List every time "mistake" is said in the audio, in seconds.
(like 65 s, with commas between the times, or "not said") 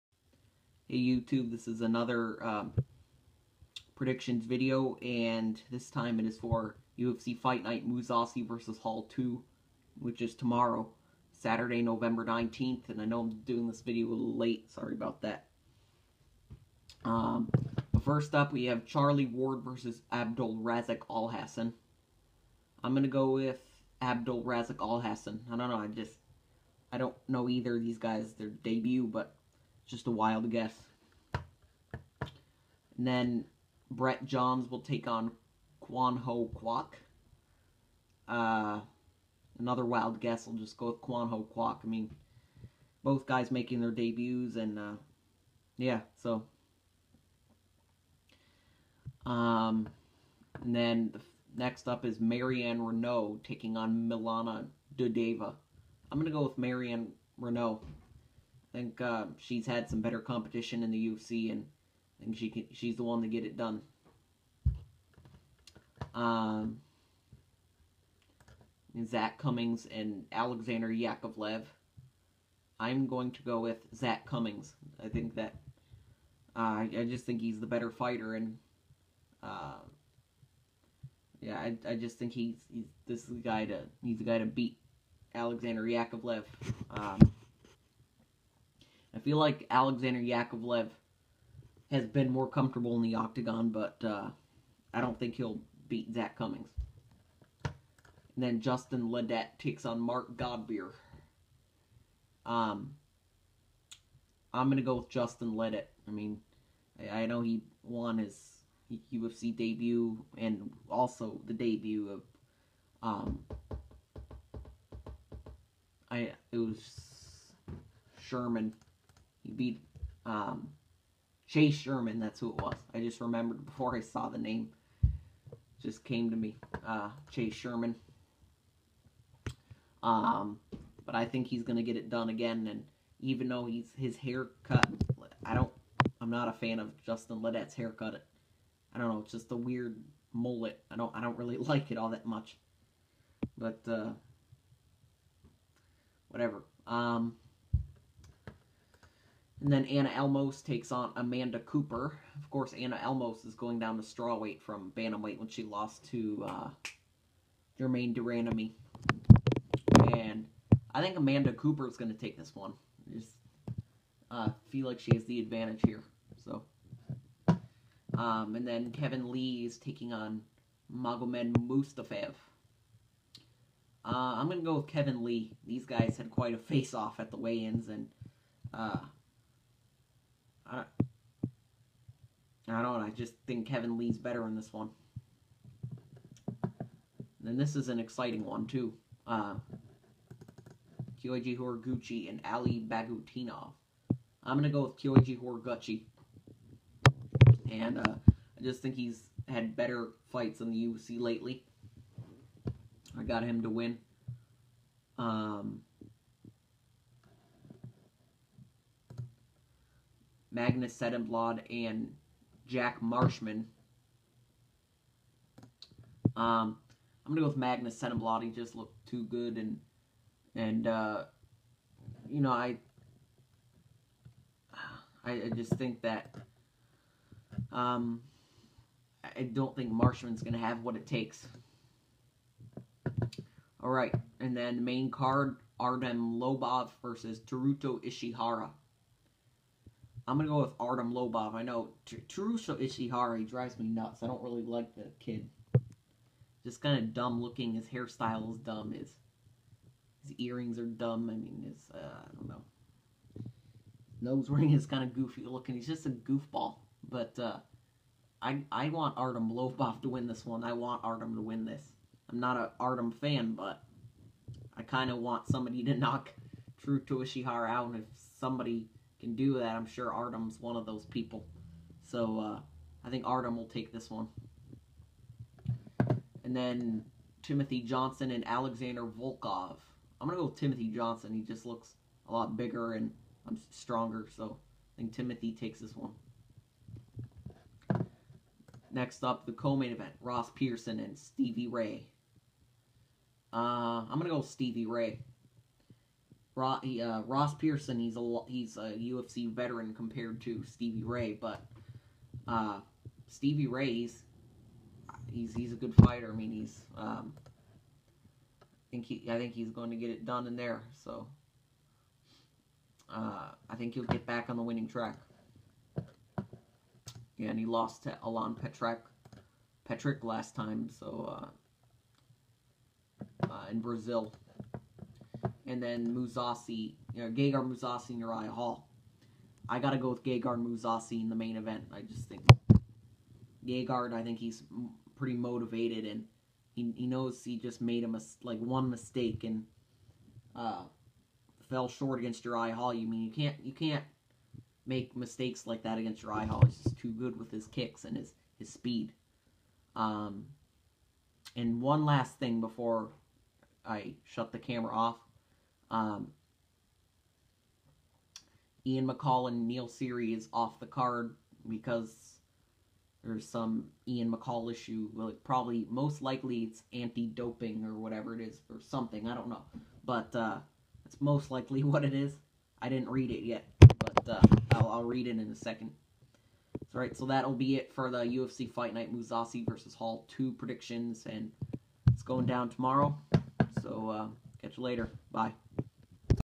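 338 s, 345 s.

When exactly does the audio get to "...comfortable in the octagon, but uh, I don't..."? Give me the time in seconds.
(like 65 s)
92 s.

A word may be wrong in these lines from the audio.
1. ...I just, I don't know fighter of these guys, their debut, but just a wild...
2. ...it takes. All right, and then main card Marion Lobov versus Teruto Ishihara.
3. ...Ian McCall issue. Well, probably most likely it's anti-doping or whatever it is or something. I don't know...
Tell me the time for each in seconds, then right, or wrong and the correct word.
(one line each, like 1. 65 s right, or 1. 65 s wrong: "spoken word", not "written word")
1. 25 s wrong: "either", not "fighter"
2. 230 s wrong: "Artem", not "Marion"
3. 364 s right.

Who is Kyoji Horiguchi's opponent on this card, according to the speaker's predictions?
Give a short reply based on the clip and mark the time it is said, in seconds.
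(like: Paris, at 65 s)
Ali Bagautinov, at 192 s.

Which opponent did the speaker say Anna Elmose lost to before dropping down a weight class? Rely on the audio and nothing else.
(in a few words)
Germaine de Randamie.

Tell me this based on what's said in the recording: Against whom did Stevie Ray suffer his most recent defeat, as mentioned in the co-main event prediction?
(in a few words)
Alan Patrick.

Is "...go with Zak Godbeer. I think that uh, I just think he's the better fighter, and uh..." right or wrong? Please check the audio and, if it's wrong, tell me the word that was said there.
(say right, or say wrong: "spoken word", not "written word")
wrong: "Cummings", not "Godbeer".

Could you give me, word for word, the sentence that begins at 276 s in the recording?
And then Timothy Johnson and Alexander Volkov.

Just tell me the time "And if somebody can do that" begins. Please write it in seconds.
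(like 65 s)
267 s.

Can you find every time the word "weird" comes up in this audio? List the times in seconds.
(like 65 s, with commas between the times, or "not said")
139 s.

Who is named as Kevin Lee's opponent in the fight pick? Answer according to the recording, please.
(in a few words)
Magomed Mustafaev.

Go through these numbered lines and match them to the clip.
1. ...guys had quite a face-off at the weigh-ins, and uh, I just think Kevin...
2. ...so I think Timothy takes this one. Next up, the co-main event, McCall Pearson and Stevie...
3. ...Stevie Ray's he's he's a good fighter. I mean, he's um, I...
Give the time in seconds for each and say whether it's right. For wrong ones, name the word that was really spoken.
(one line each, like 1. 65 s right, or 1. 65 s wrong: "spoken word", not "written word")
1. 175 s right
2. 284 s wrong: "Ross", not "McCall"
3. 303 s right.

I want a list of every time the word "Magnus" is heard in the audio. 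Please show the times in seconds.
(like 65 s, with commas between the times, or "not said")
210 s, 217 s.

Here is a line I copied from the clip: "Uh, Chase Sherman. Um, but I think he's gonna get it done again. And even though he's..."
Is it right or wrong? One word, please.
right.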